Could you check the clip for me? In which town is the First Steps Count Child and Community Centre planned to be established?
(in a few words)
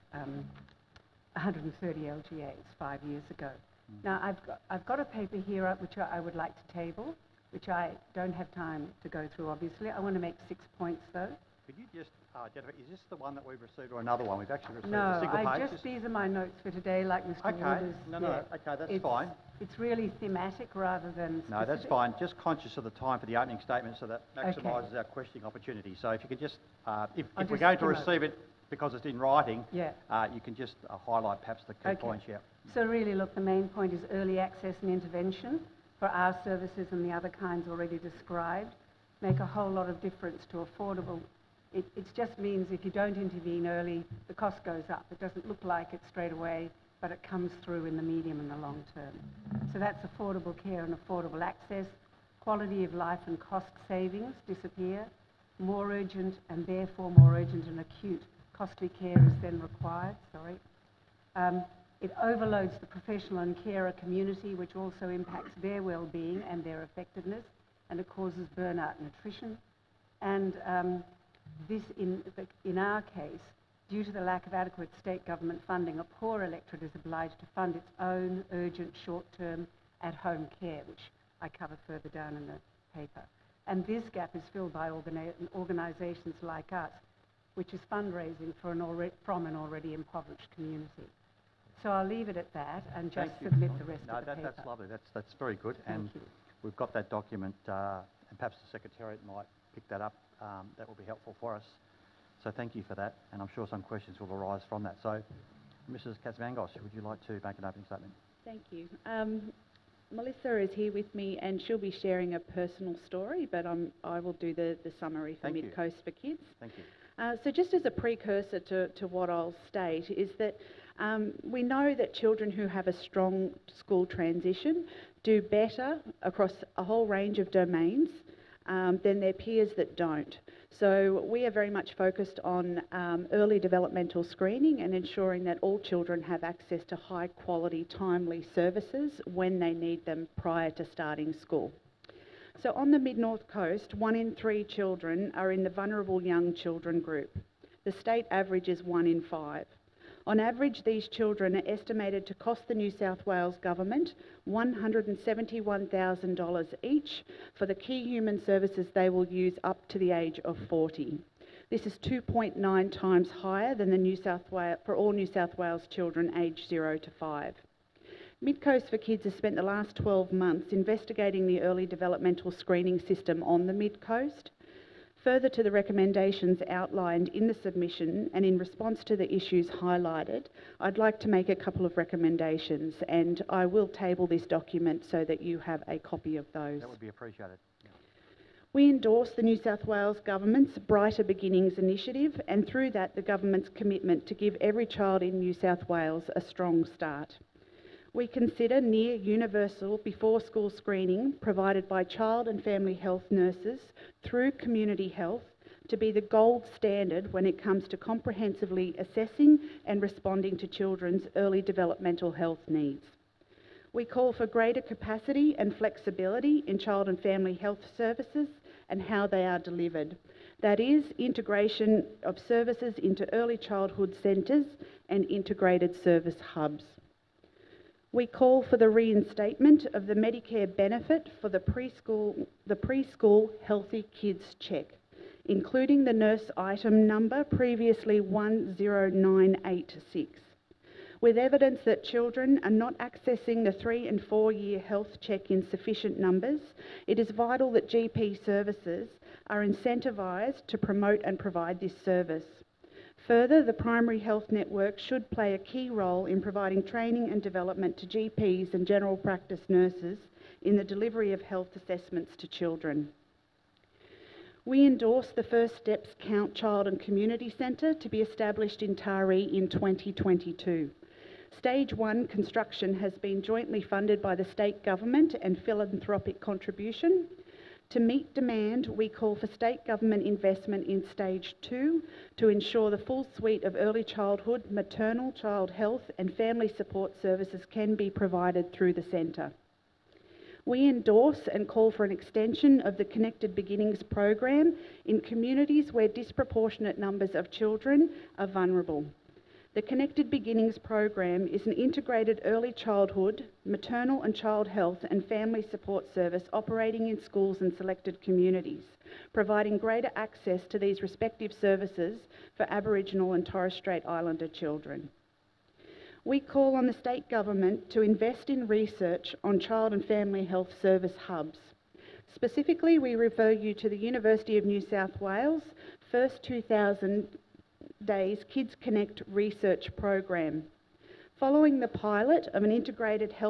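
Taree.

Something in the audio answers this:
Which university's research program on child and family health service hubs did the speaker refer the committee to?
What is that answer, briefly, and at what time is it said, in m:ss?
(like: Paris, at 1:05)
University of New South Wales, at 5:23.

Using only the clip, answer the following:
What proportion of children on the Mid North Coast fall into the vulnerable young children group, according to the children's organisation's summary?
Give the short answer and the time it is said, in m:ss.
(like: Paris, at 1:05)
1 in 3, at 2:23.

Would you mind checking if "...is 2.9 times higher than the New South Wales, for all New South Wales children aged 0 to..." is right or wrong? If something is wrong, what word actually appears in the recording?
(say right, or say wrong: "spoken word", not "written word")
right.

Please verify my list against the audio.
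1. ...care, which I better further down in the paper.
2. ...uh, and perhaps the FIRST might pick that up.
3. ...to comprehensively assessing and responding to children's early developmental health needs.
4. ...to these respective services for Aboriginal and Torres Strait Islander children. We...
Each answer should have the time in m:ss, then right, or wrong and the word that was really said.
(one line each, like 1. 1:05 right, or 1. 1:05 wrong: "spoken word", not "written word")
1. 1:20 wrong: "cover", not "better"
2. 1:37 wrong: "Secretariat", not "FIRST"
3. 3:27 right
4. 5:10 right.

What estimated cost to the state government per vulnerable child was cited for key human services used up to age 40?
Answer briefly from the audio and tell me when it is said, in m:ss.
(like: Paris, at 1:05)
$171,000, at 2:34.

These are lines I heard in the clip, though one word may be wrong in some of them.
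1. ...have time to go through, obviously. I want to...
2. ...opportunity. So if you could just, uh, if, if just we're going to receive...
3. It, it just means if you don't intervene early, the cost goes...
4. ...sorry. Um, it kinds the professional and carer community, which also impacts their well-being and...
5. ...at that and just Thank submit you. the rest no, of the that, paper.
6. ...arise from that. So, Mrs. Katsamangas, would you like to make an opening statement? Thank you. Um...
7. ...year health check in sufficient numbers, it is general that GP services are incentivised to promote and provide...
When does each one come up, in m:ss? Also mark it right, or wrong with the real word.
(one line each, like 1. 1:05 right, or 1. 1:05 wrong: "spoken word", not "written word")
1. 0:08 right
2. 0:25 right
3. 0:41 right
4. 1:00 wrong: "overloads", not "kinds"
5. 1:32 right
6. 1:44 right
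7. 4:04 wrong: "vital", not "general".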